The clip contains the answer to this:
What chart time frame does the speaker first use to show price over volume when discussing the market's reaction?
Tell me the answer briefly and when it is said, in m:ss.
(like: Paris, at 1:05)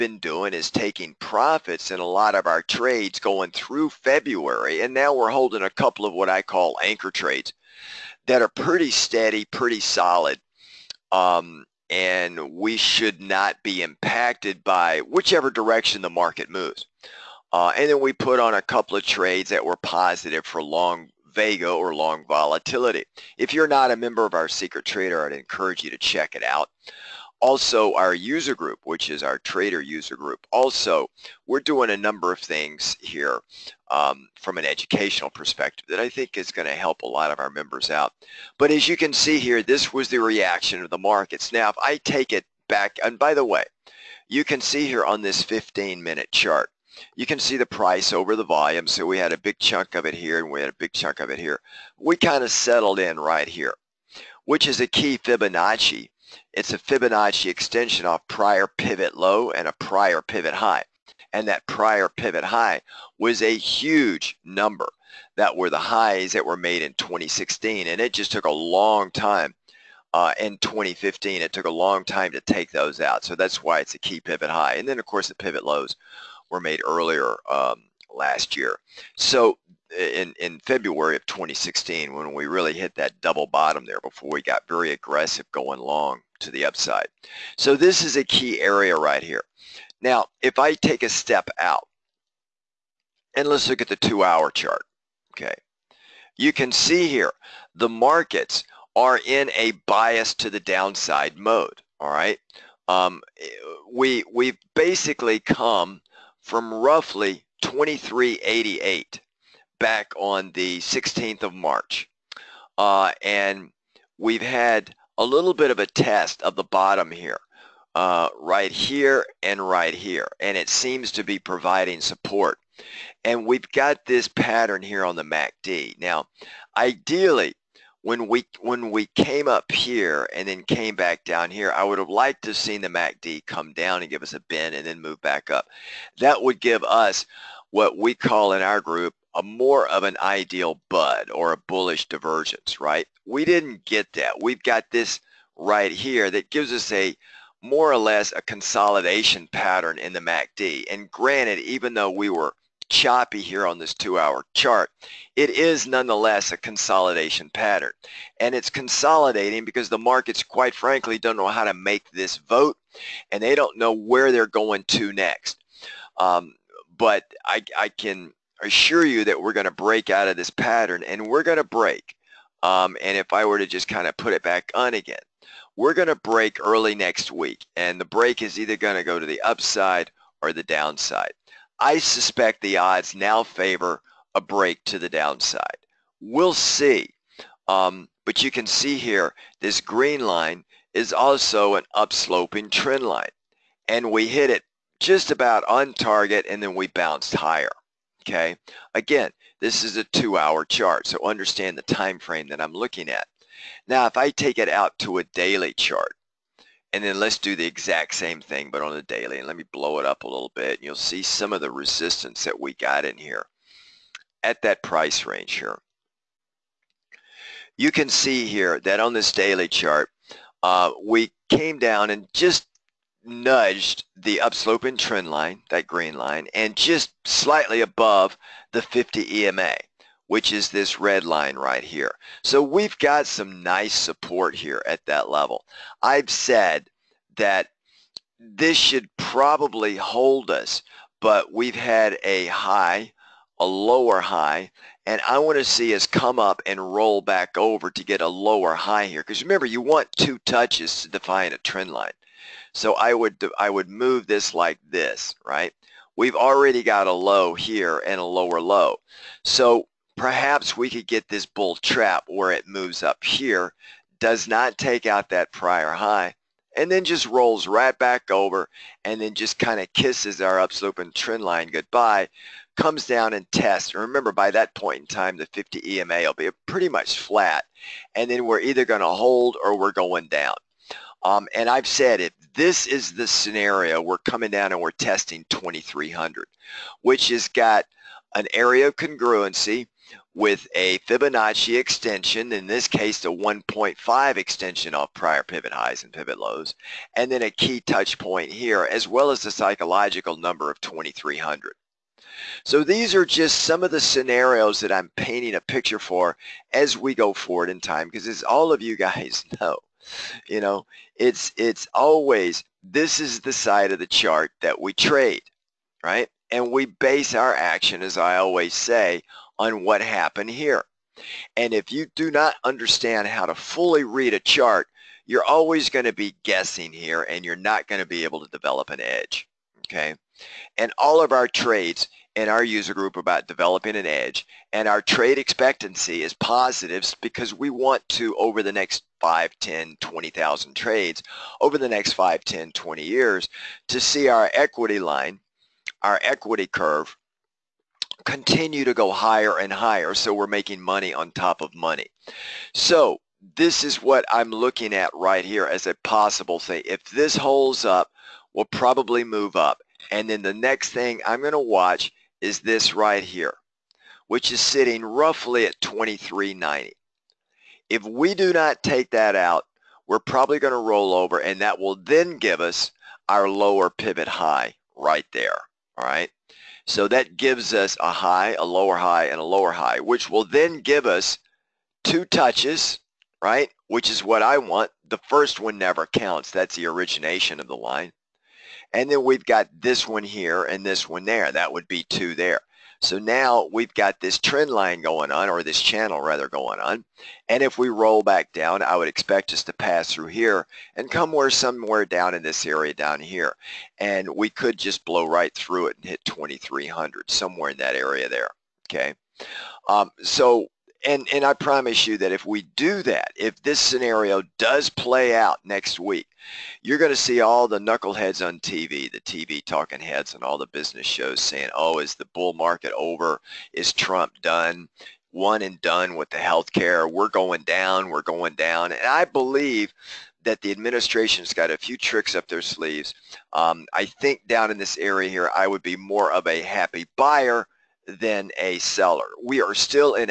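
15-minute, at 0:45.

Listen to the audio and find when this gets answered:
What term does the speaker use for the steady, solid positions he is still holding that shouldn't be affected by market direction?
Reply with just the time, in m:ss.
0:06.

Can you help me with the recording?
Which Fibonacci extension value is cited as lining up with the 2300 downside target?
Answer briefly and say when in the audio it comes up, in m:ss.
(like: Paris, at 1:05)
1.5, at 4:53.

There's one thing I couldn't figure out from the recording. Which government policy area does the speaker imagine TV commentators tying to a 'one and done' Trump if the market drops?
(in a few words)
health care.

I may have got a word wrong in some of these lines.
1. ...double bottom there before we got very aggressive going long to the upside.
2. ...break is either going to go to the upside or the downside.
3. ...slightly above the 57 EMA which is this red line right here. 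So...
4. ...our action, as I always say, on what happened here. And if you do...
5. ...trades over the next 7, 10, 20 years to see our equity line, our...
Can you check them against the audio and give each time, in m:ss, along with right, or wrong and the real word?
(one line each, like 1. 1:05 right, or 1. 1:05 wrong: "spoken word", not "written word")
1. 1:23 right
2. 2:58 right
3. 3:47 wrong: "50", not "57"
4. 5:17 right
5. 5:40 wrong: "5", not "7".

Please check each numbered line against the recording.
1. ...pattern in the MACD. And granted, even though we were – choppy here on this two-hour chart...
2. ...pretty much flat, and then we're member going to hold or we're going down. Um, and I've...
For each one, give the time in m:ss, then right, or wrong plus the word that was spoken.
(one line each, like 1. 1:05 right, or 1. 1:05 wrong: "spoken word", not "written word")
1. 2:29 right
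2. 4:36 wrong: "either", not "member".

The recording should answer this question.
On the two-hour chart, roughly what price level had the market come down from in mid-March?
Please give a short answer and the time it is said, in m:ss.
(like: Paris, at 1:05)
2388, at 1:47.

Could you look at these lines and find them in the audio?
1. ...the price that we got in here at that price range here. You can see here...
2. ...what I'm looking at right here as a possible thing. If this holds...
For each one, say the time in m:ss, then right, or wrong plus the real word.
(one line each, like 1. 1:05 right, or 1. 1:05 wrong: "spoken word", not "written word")
1. 3:31 wrong: "resistance", not "price"
2. 5:54 right.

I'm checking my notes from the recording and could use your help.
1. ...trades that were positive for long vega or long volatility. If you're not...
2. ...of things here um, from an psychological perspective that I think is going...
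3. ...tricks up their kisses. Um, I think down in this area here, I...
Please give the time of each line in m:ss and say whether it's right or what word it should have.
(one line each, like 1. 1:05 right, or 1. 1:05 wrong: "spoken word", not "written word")
1. 0:19 right
2. 0:32 wrong: "educational", not "psychological"
3. 7:11 wrong: "sleeves", not "kisses".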